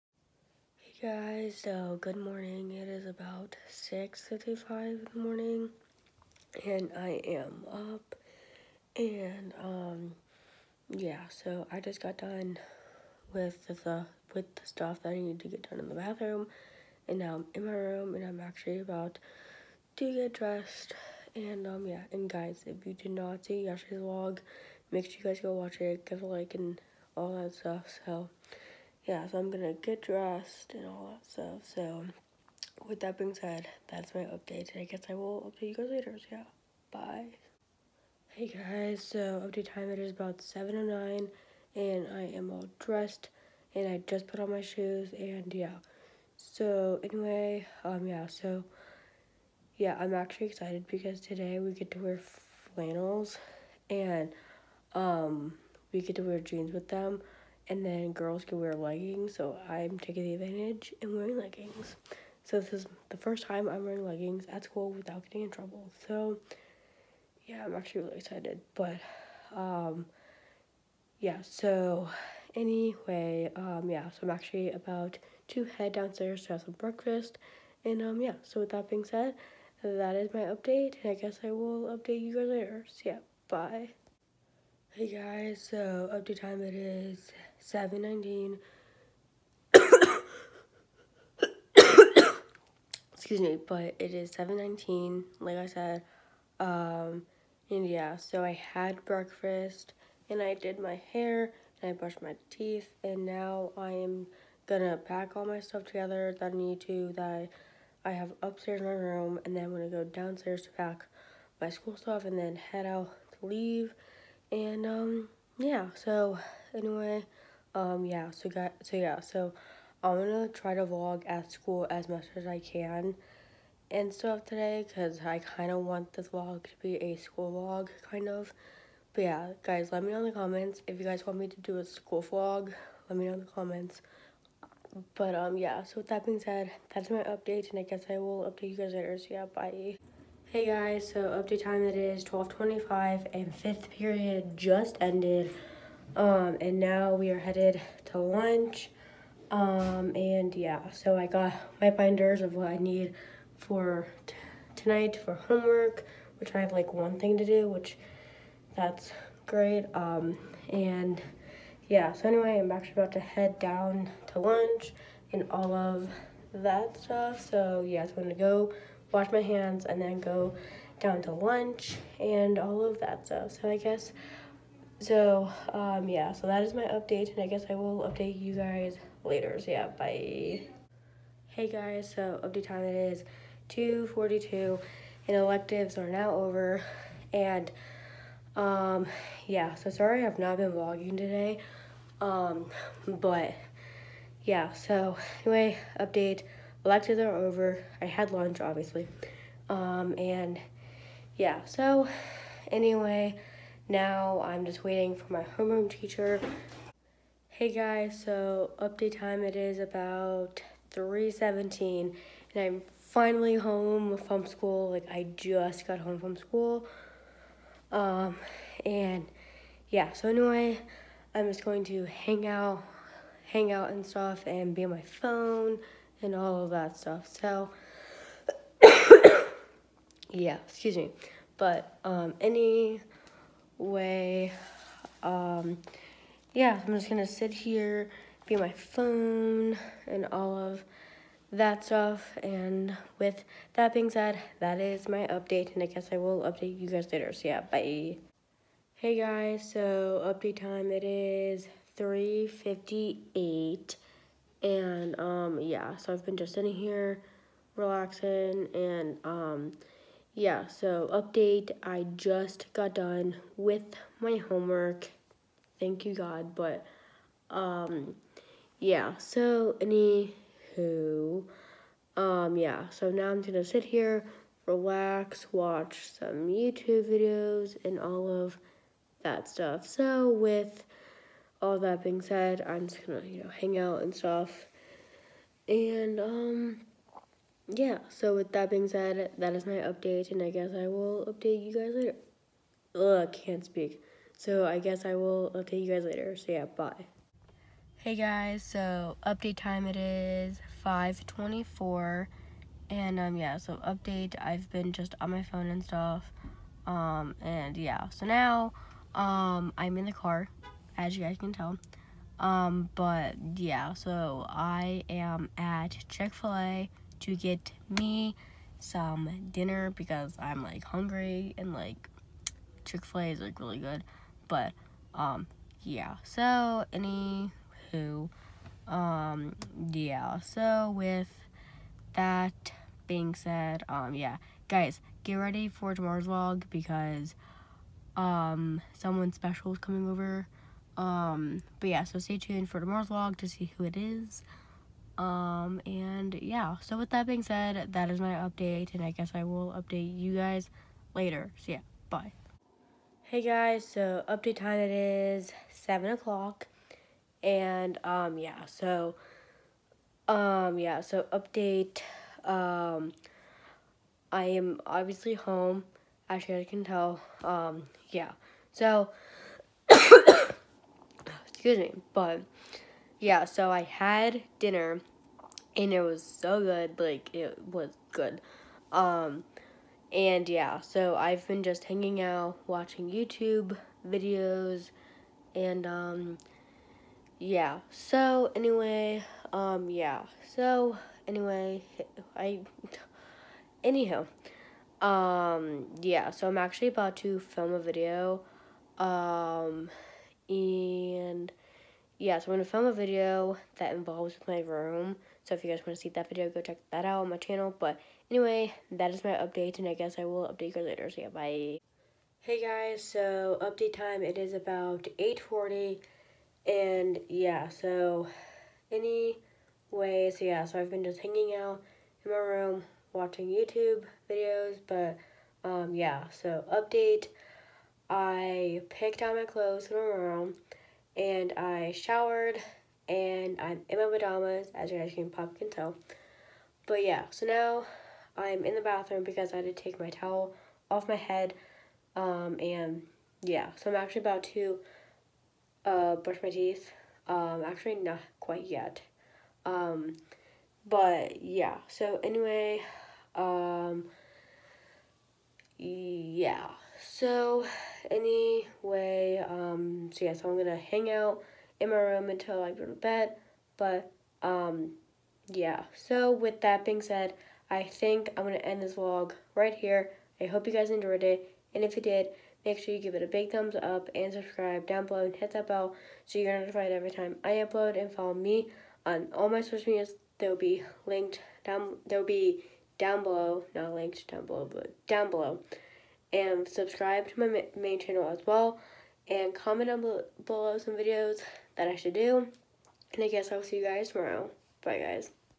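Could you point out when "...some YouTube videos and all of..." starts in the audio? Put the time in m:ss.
4:36.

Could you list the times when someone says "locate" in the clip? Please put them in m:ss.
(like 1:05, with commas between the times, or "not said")
not said.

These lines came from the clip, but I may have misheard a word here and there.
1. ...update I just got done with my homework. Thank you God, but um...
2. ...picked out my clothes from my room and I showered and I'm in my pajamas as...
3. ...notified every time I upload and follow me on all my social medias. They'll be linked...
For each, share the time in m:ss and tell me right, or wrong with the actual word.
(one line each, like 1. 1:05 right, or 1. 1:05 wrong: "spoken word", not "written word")
1. 4:21 right
2. 7:08 right
3. 7:56 right.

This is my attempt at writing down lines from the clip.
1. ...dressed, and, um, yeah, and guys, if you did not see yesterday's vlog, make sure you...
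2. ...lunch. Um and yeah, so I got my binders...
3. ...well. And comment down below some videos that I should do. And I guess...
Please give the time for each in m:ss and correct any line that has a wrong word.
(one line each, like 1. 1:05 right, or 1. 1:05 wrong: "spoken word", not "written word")
1. 0:20 right
2. 2:28 right
3. 8:08 right.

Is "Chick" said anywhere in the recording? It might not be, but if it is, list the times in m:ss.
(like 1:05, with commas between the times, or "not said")
5:16, 5:22.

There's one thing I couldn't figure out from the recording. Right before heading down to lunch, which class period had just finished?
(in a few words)
Fifth period.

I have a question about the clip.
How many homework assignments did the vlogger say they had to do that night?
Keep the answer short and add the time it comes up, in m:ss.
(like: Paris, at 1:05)
One, at 2:36.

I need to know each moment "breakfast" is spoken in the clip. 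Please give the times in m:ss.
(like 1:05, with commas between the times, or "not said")
1:16, 1:39.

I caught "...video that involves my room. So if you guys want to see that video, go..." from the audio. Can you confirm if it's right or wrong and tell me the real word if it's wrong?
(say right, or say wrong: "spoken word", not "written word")
right.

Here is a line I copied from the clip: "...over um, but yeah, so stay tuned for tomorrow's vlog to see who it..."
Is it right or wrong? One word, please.
right.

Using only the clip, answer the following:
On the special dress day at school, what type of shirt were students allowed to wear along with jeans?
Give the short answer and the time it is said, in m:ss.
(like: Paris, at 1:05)
Flannels, at 0:52.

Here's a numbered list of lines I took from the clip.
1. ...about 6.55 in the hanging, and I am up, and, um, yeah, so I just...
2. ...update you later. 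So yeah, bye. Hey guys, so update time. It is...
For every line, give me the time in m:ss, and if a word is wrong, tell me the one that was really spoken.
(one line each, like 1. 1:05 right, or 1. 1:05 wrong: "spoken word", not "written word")
1. 0:03 wrong: "morning", not "hanging"
2. 6:50 right.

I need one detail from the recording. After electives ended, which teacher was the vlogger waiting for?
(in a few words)
Homeroom teacher.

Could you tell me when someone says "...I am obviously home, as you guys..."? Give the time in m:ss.
6:04.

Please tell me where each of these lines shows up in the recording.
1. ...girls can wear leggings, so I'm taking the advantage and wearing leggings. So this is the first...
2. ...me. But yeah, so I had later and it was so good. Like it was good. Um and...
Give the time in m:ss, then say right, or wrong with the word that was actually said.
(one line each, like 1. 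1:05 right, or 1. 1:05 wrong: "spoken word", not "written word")
1. 0:58 right
2. 6:11 wrong: "dinner", not "later".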